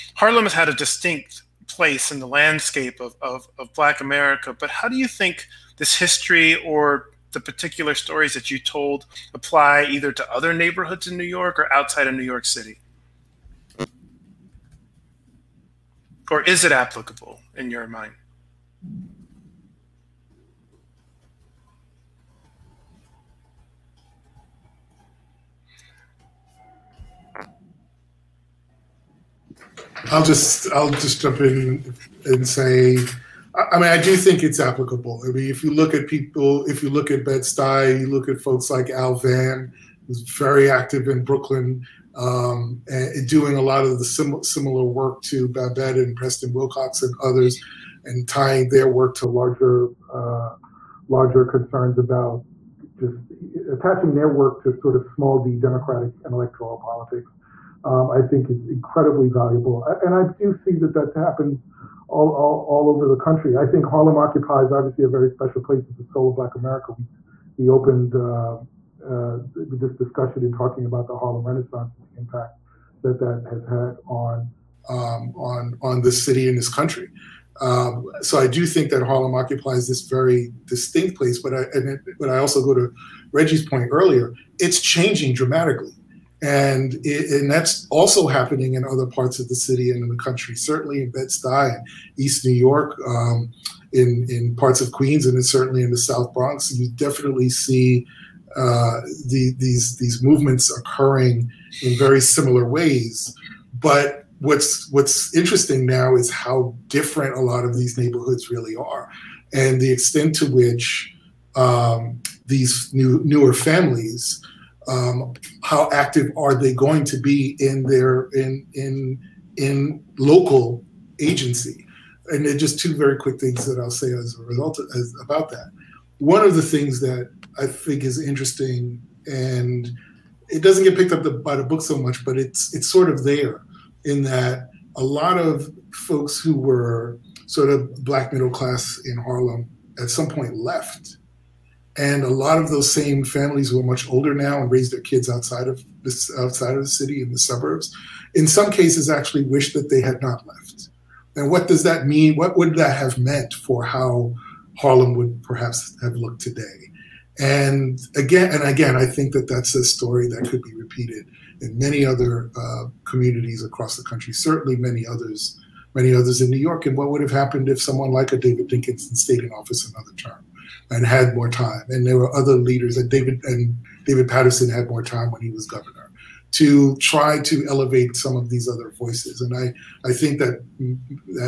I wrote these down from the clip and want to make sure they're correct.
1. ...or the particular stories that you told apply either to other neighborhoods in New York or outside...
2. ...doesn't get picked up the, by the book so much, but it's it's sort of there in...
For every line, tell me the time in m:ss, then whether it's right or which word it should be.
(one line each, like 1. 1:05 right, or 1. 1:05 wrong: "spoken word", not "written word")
1. 0:06 right
2. 2:10 right.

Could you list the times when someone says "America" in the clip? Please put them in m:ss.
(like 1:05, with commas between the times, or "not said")
0:03, 1:06.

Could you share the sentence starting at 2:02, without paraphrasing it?
And they're just two very quick things that I'll say as a result of, as, about that.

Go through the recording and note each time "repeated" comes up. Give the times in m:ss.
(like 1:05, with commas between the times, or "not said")
2:40.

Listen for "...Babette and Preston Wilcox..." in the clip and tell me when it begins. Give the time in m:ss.
0:45.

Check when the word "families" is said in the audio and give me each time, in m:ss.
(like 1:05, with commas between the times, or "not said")
1:53, 2:23.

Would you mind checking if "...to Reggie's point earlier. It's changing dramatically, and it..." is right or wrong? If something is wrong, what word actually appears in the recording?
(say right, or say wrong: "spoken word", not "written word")
right.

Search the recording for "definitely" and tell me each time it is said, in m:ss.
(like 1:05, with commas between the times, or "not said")
1:36.